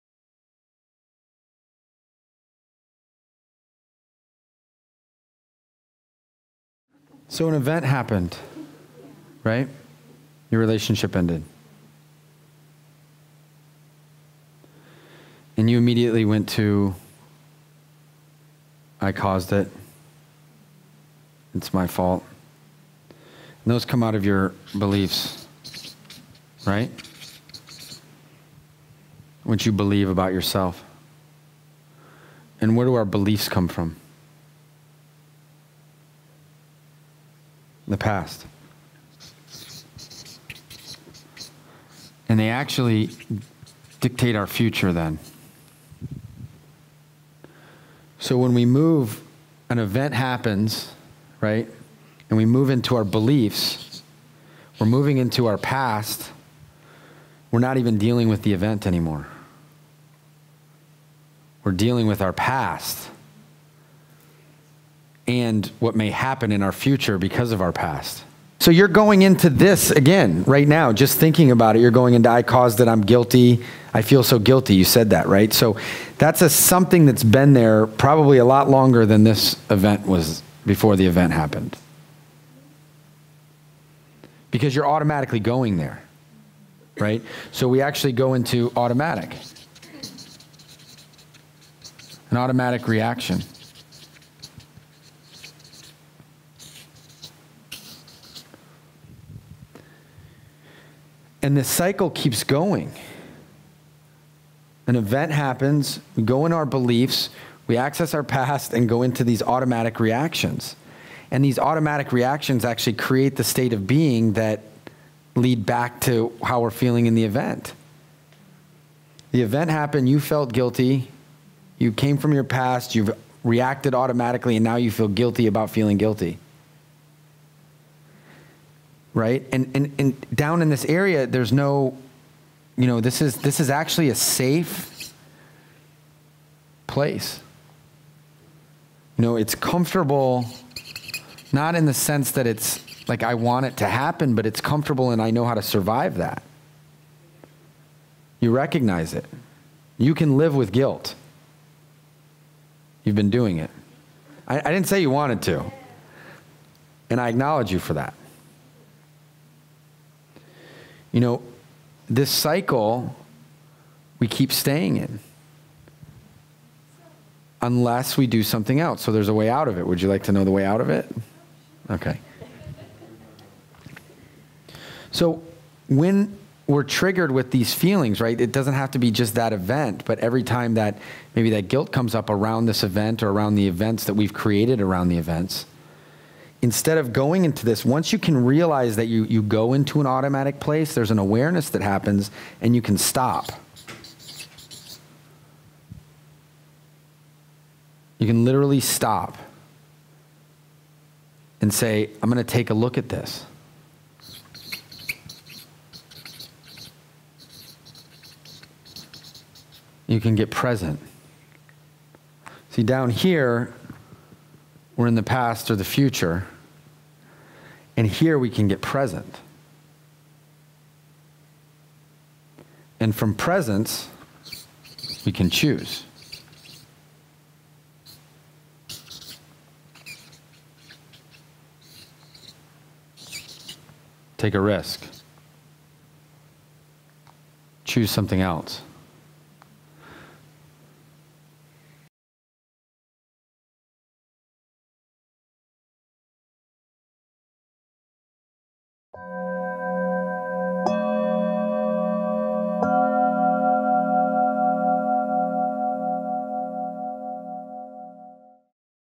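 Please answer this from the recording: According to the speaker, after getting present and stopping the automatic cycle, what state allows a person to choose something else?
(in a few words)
presence.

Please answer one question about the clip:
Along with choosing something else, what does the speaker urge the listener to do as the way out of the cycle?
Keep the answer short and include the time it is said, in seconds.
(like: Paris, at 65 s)
Take a risk, at 234 s.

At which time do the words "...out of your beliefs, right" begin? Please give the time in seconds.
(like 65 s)
24 s.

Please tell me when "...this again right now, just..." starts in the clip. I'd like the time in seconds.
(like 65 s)
69 s.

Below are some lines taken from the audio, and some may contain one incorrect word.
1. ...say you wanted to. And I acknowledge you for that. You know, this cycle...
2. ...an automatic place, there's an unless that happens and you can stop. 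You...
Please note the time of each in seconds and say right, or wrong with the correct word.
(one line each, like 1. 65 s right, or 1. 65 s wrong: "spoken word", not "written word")
1. 154 s right
2. 189 s wrong: "awareness", not "unless".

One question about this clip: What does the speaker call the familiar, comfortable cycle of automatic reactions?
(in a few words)
a safe place.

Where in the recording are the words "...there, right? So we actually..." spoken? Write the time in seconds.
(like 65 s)
85 s.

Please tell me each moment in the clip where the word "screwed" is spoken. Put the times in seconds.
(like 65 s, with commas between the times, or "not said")
not said.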